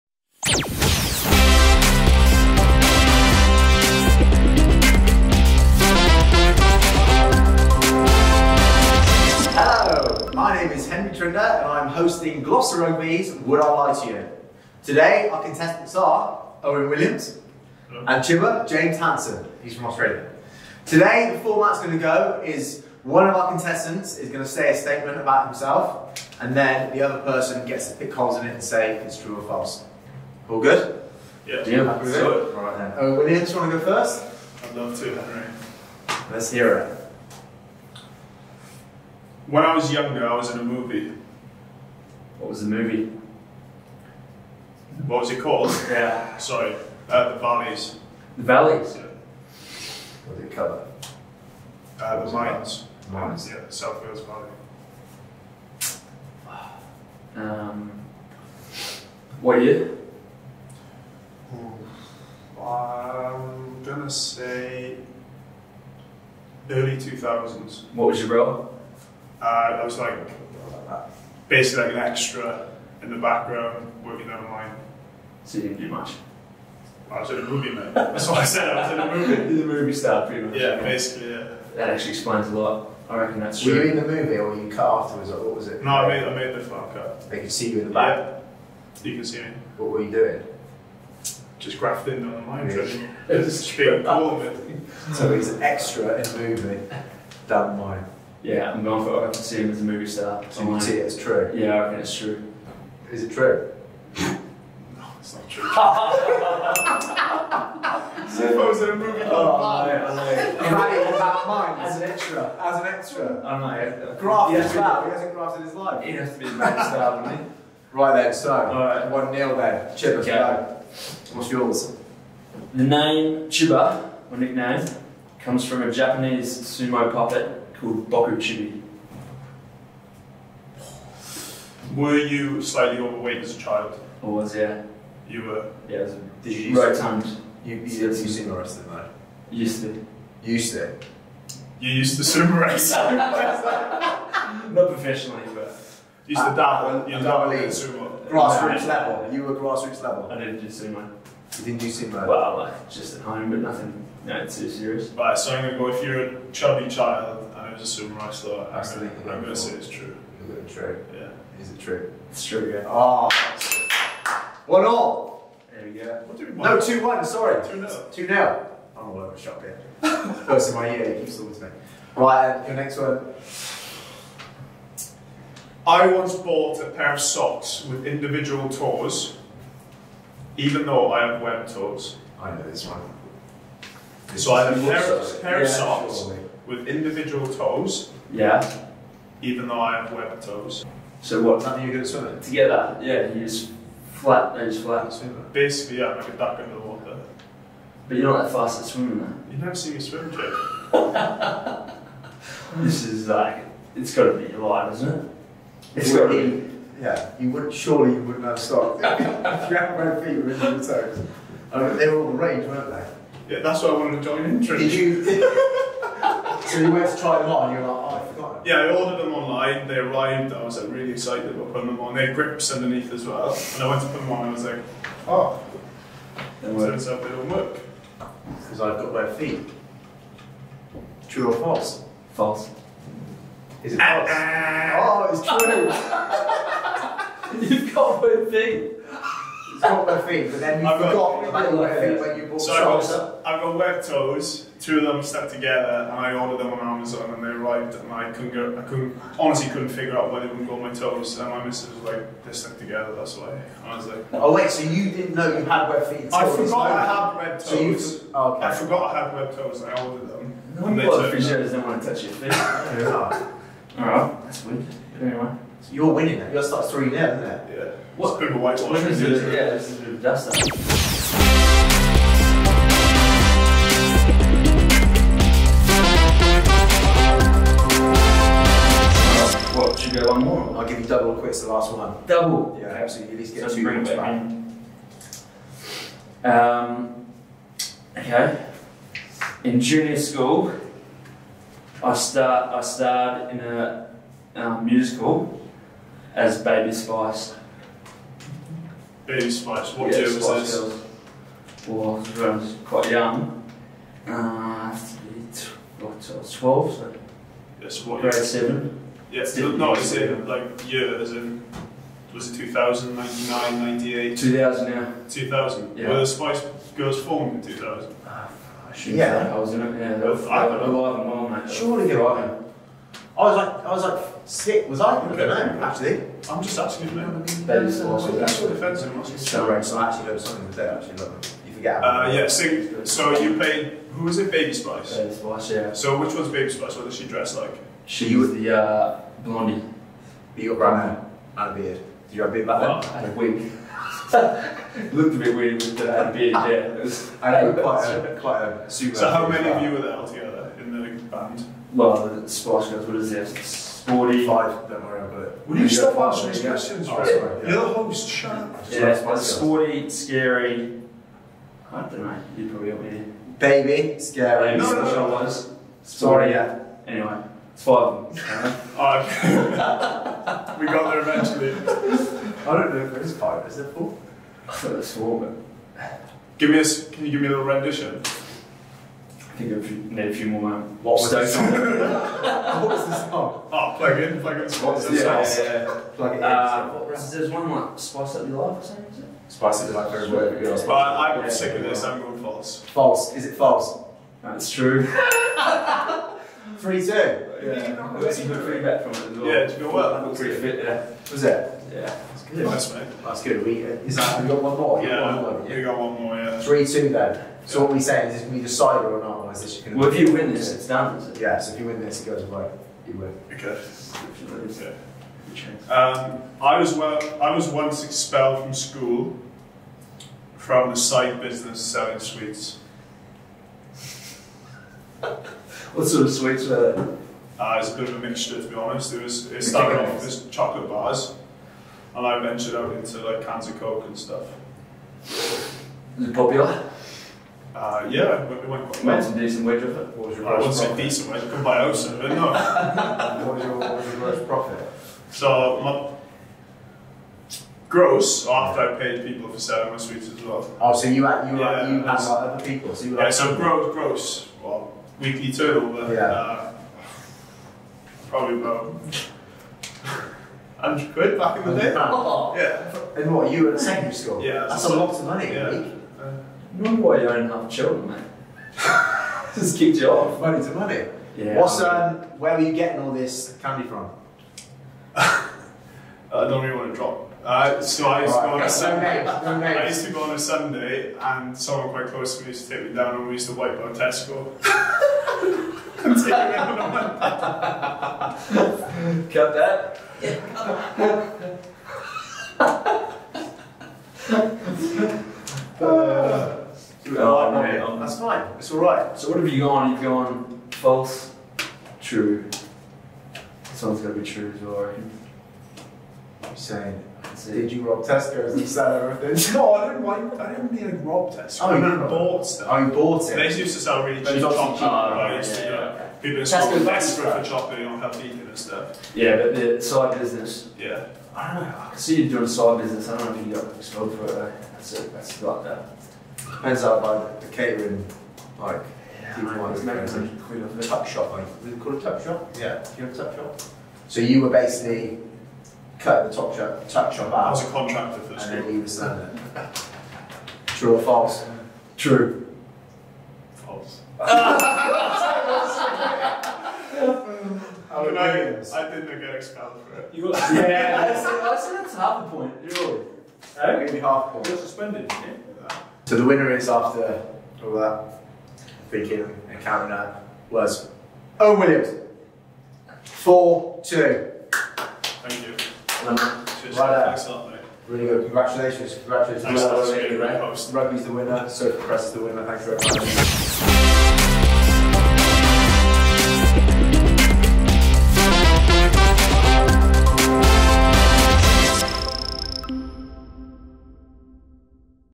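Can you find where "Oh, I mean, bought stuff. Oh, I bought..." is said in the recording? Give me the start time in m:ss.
8:31.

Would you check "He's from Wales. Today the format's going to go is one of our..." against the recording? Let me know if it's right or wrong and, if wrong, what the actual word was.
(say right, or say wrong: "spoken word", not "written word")
wrong: "Australia", not "Wales".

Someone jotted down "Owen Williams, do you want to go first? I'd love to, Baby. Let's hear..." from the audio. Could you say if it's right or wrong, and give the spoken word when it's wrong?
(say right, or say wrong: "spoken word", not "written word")
wrong: "Henry", not "Baby".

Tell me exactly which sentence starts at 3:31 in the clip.
I mean, they were all the weren't they?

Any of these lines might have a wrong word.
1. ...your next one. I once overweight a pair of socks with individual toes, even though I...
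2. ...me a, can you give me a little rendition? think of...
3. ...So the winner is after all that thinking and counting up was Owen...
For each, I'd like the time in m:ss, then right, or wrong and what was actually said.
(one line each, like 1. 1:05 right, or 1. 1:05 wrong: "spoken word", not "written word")
1. 2:52 wrong: "bought", not "overweight"
2. 6:16 right
3. 9:16 right.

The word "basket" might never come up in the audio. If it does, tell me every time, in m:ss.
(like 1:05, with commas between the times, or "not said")
not said.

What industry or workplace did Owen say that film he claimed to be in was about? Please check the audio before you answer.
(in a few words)
The mines.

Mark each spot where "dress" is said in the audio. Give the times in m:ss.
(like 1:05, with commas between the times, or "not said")
5:37.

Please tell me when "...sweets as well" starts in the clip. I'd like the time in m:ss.
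7:29.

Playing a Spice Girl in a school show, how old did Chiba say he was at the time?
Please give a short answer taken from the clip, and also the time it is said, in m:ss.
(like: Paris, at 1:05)
12, at 5:06.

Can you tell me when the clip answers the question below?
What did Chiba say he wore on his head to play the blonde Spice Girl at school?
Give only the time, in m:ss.
5:43.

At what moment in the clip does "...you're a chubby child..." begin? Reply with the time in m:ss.
2:36.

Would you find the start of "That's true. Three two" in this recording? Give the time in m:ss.
6:34.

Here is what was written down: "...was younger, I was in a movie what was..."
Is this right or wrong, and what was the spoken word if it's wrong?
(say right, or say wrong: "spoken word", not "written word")
right.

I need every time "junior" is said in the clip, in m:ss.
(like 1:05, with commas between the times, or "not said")
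4:49.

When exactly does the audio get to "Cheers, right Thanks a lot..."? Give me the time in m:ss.
9:25.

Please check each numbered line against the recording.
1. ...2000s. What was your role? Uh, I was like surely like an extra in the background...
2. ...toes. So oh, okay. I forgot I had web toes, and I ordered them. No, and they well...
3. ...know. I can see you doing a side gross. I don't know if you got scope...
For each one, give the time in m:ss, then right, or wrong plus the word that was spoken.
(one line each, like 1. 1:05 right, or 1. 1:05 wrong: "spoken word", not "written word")
1. 1:06 wrong: "basically", not "surely"
2. 4:17 right
3. 8:41 wrong: "business", not "gross".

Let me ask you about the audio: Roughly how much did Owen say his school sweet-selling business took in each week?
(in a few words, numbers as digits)
£100.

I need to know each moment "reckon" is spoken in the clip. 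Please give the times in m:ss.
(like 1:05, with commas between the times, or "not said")
1:23, 1:41.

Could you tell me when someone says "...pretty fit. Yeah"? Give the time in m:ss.
6:40.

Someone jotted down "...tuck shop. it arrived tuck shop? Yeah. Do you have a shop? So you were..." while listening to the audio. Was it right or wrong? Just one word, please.
wrong.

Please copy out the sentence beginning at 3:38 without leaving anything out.
Yeah, I ordered them online, they arrived, I was like, really excited about putting them on.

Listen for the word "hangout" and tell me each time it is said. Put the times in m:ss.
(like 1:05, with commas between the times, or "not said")
not said.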